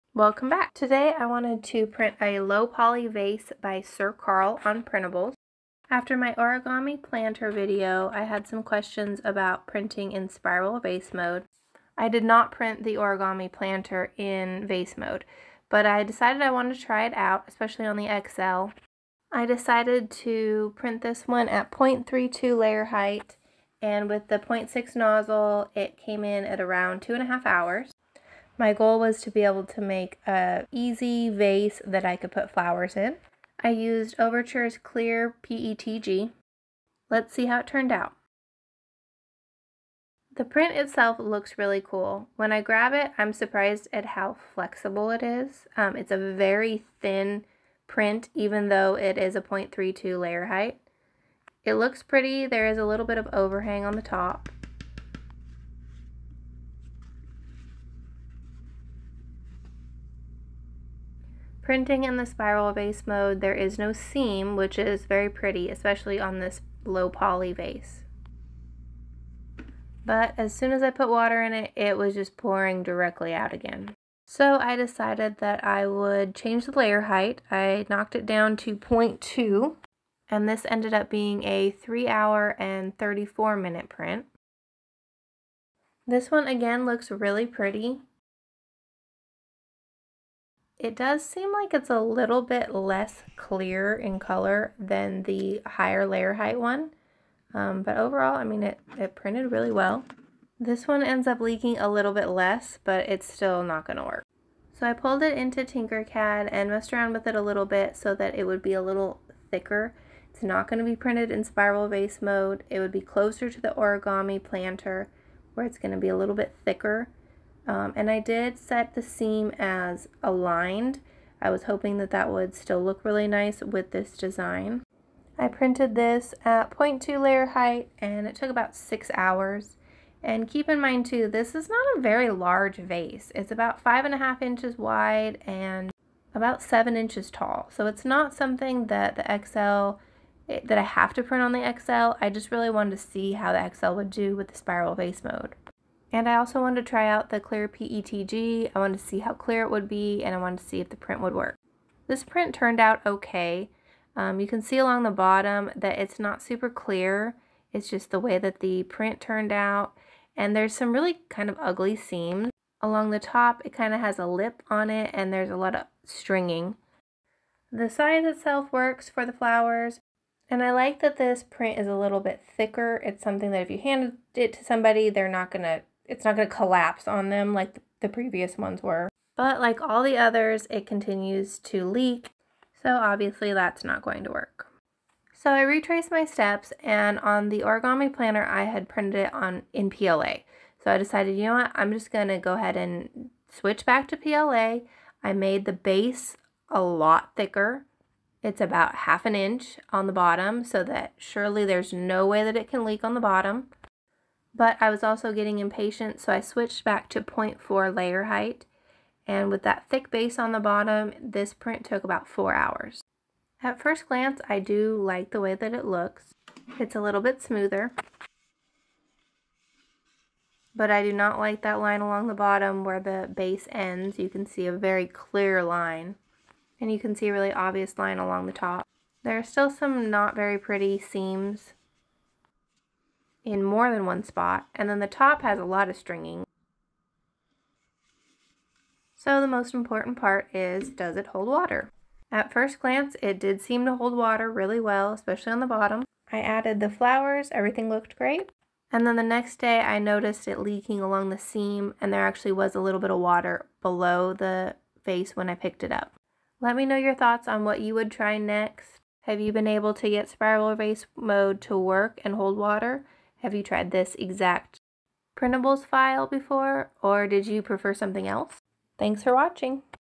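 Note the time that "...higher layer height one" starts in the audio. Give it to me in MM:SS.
01:35.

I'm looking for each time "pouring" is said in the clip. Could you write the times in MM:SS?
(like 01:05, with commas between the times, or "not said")
01:12.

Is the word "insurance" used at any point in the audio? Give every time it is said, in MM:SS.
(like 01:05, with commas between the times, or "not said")
not said.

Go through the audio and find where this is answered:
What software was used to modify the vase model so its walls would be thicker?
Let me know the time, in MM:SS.
01:45.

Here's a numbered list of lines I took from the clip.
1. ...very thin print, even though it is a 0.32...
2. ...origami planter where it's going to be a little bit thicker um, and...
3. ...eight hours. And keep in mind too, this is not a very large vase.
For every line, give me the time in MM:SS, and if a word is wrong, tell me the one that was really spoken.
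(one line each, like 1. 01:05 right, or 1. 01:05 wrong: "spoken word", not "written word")
1. 00:46 right
2. 01:53 right
3. 02:08 wrong: "six", not "eight".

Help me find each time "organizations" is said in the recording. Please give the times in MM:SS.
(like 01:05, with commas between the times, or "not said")
not said.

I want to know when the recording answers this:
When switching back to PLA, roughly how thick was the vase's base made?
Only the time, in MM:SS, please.
03:18.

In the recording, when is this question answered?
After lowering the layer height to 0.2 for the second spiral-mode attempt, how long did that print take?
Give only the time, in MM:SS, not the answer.
01:21.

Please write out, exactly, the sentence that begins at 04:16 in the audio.
Let me know your thoughts on what you would try next.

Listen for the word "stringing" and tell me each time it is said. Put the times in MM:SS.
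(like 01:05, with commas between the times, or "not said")
02:46, 03:55.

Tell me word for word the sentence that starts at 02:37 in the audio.
It's just the way that the print turned out.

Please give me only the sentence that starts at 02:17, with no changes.
So it's not something that the XL, eh, that I have to print on the XL.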